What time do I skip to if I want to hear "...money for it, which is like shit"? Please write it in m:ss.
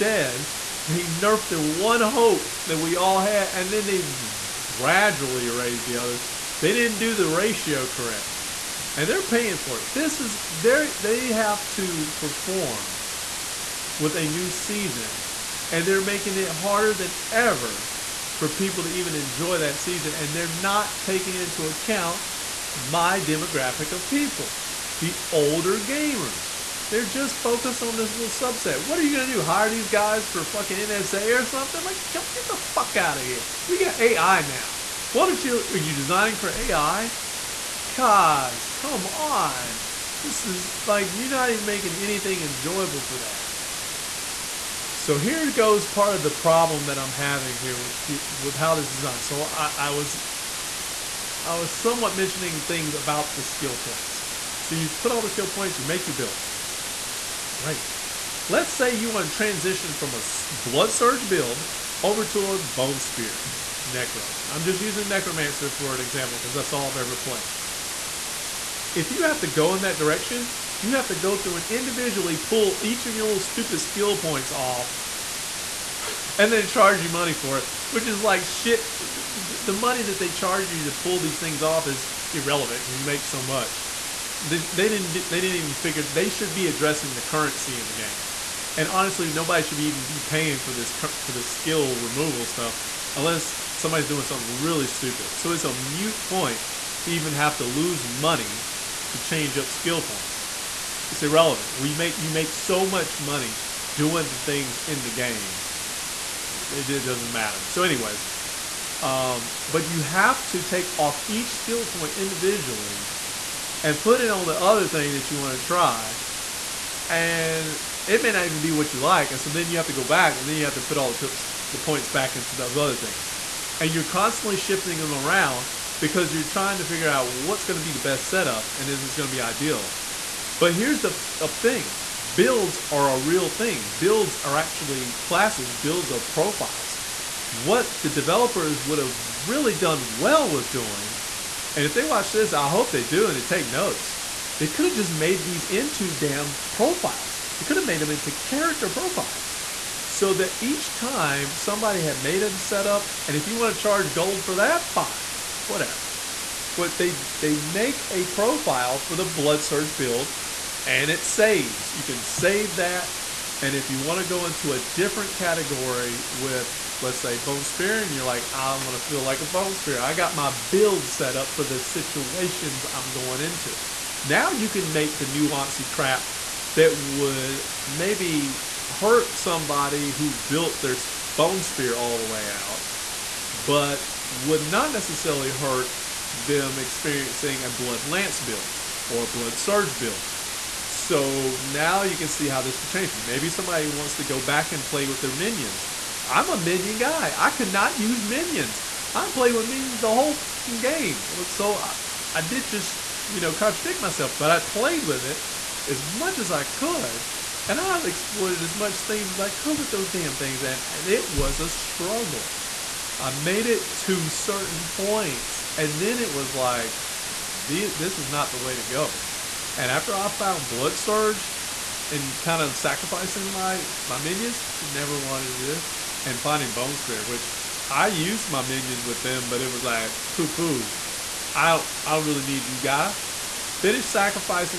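1:17.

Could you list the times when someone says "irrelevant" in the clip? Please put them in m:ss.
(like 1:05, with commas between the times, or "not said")
1:22, 1:41.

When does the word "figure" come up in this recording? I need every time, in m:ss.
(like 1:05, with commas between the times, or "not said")
1:25, 2:06.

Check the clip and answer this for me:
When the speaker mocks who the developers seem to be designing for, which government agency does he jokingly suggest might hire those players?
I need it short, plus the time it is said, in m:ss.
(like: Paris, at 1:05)
NSA, at 0:30.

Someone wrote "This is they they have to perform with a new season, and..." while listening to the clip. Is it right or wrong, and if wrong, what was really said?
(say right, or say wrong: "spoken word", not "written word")
right.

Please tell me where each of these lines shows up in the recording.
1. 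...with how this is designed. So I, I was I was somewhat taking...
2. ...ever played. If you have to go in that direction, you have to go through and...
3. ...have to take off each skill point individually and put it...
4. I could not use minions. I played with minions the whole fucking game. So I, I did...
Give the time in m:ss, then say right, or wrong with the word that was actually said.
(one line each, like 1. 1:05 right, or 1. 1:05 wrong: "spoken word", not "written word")
1. 0:48 wrong: "mentioning", not "taking"
2. 1:06 right
3. 1:50 right
4. 3:17 right.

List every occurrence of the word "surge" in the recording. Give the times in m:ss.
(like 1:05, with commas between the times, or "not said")
1:00, 2:39, 3:09, 3:40.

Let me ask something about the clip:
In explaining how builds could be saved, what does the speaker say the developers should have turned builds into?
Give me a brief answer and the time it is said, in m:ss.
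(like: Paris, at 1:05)
Character profiles, at 2:28.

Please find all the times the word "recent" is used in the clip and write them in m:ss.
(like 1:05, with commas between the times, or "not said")
not said.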